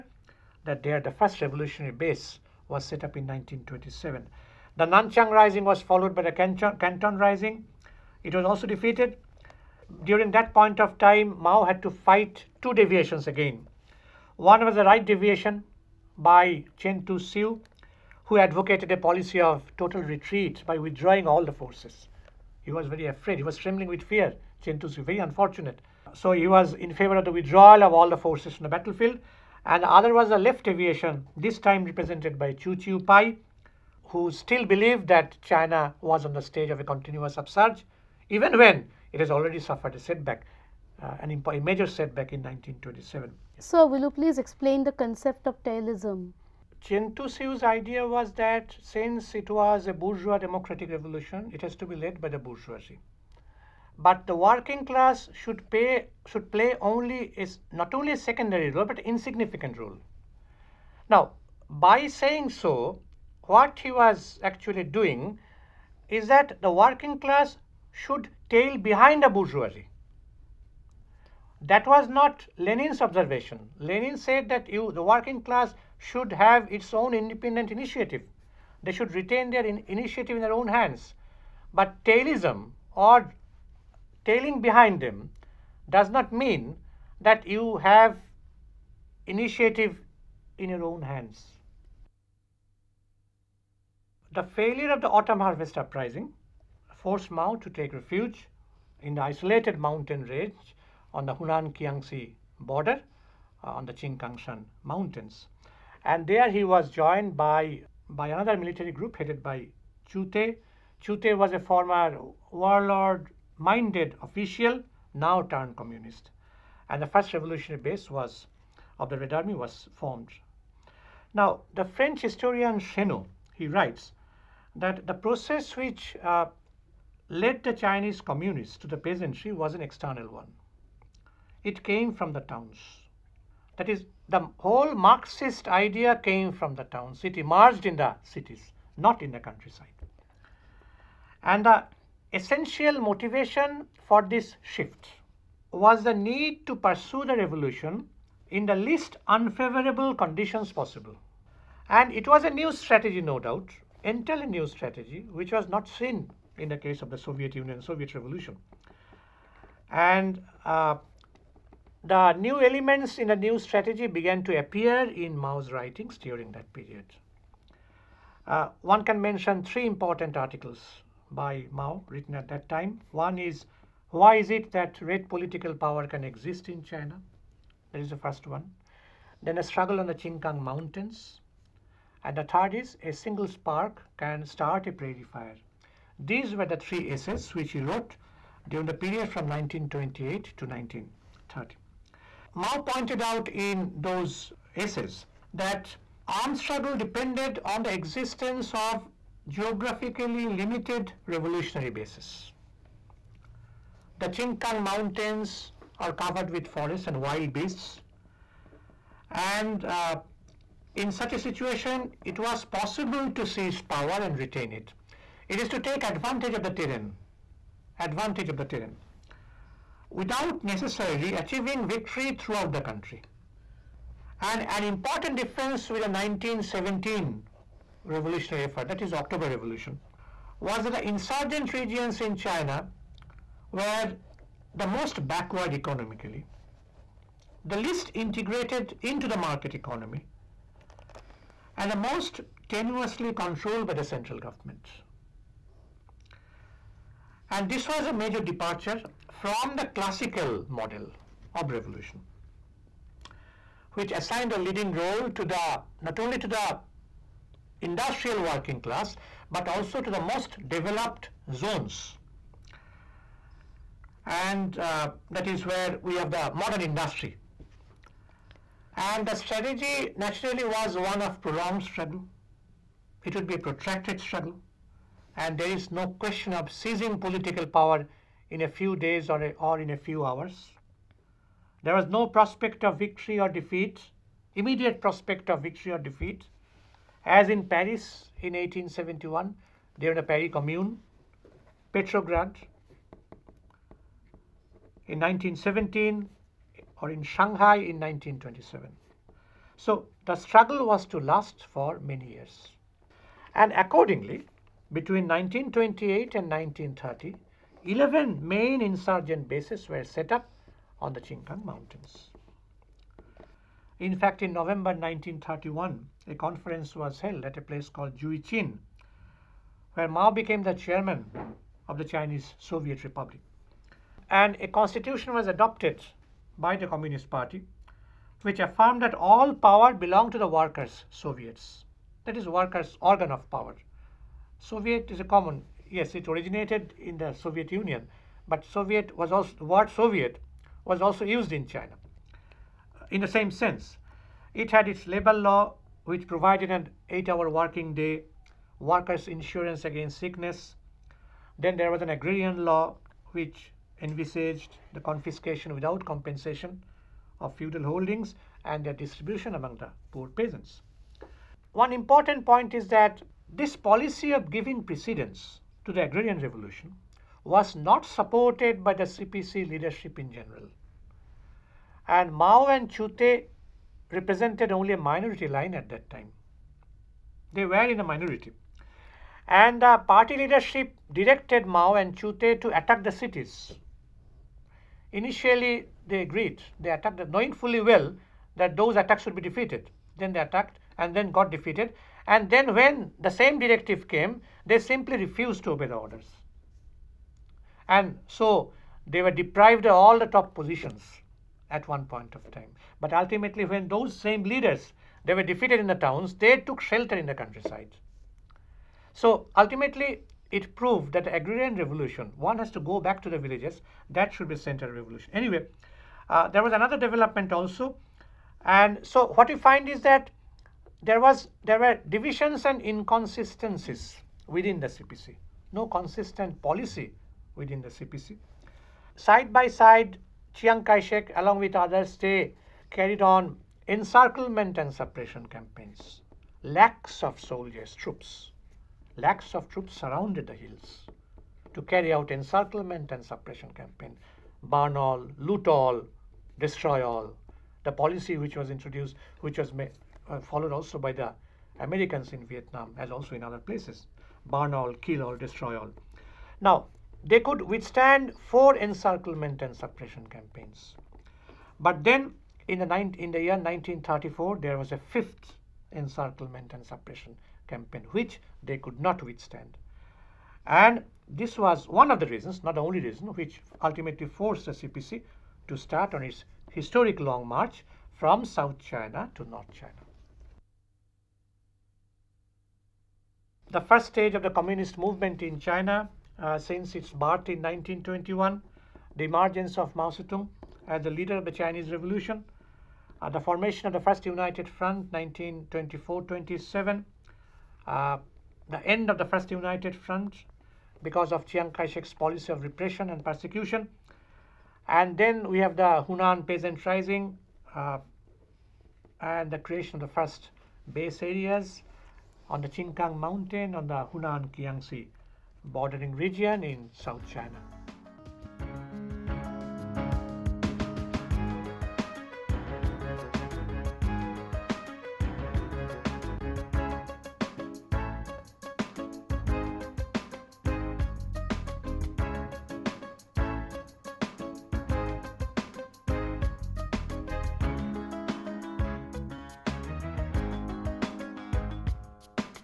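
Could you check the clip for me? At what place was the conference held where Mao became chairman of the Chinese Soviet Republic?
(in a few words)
Juichin.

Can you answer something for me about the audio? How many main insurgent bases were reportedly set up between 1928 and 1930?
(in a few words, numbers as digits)
11.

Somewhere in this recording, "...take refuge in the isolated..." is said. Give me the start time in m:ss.
1:37.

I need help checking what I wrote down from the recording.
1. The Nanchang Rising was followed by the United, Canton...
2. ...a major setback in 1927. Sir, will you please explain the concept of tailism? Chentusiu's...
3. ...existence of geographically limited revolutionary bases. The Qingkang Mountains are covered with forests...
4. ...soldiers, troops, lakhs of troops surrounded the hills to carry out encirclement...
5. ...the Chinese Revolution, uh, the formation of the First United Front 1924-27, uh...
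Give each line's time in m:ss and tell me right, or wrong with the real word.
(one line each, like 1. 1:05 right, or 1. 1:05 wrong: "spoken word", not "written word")
1. 0:04 wrong: "Canton", not "United"
2. 0:41 right
3. 3:17 right
4. 7:17 right
5. 8:11 right.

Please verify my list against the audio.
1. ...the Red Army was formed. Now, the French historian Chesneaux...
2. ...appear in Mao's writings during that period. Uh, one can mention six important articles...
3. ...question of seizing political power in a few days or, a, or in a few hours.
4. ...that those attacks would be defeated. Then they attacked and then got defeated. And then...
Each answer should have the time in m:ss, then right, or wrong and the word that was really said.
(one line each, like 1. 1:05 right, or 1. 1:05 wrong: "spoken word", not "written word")
1. 1:59 right
2. 2:44 wrong: "three", not "six"
3. 4:36 right
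4. 6:28 right.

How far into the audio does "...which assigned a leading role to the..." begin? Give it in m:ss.
4:13.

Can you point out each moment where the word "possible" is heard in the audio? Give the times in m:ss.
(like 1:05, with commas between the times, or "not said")
2:30, 3:32.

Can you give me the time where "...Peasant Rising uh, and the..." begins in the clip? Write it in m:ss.
8:26.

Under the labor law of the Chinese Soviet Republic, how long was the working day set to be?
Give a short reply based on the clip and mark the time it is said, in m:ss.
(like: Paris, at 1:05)
8 hours, at 5:47.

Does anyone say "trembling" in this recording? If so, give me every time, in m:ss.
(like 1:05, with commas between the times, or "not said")
0:23.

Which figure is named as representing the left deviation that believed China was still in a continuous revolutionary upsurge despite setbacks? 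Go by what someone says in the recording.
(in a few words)
Chu Chiu Pai.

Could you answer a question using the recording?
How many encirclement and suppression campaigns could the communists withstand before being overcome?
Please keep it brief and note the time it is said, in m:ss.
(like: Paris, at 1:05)
4, at 7:38.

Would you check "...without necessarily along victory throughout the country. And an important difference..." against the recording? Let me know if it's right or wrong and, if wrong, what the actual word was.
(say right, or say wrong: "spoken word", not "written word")
wrong: "achieving", not "along".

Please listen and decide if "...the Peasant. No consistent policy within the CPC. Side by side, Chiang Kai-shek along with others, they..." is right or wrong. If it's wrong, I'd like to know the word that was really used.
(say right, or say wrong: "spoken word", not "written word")
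wrong: "CPC", not "Peasant".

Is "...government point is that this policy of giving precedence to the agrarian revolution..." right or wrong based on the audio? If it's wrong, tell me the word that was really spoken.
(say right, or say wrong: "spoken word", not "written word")
wrong: "important", not "government".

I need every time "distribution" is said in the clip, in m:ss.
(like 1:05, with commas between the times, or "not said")
5:58.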